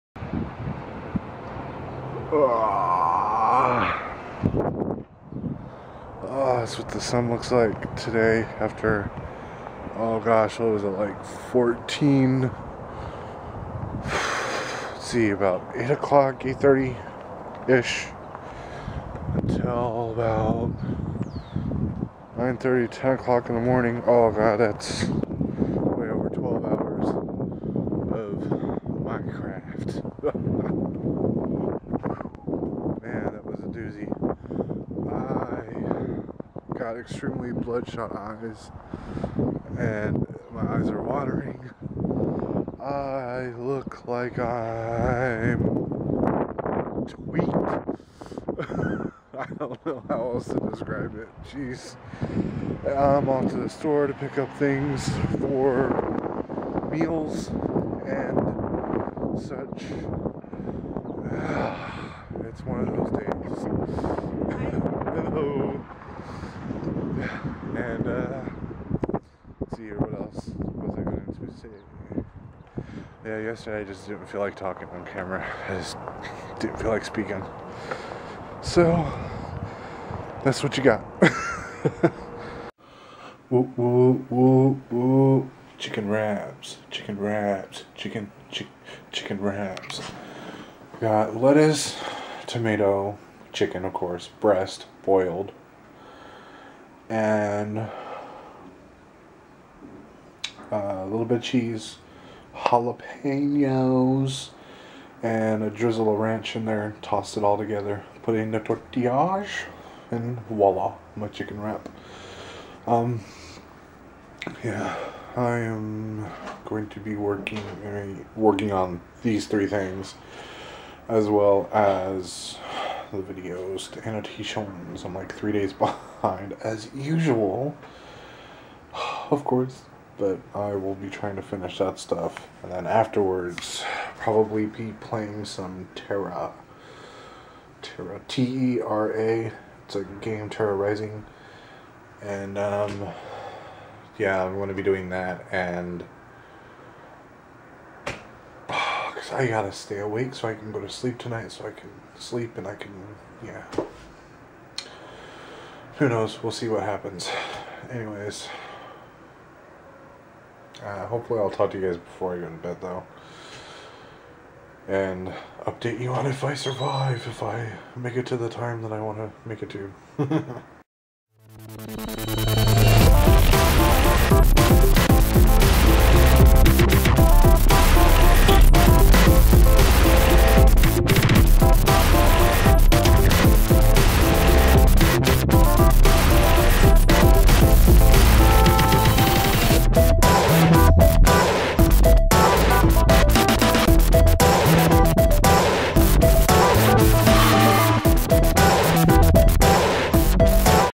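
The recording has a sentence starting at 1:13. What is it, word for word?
Yeah, yesterday I just didn't feel like talking on camera.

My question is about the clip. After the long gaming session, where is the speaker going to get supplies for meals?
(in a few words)
The store.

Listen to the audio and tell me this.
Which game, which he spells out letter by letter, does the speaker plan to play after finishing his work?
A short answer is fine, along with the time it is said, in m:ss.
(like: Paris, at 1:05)
TERA Rising, at 2:20.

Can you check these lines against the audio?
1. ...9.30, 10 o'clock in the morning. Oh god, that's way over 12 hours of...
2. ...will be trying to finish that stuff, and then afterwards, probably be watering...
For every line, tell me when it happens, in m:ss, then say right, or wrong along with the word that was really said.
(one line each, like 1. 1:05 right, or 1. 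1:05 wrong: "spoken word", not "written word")
1. 0:22 right
2. 2:10 wrong: "playing", not "watering".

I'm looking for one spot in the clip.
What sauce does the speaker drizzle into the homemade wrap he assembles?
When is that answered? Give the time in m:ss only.
1:46.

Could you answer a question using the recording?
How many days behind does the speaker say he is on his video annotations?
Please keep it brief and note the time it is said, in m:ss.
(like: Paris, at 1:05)
3, at 2:05.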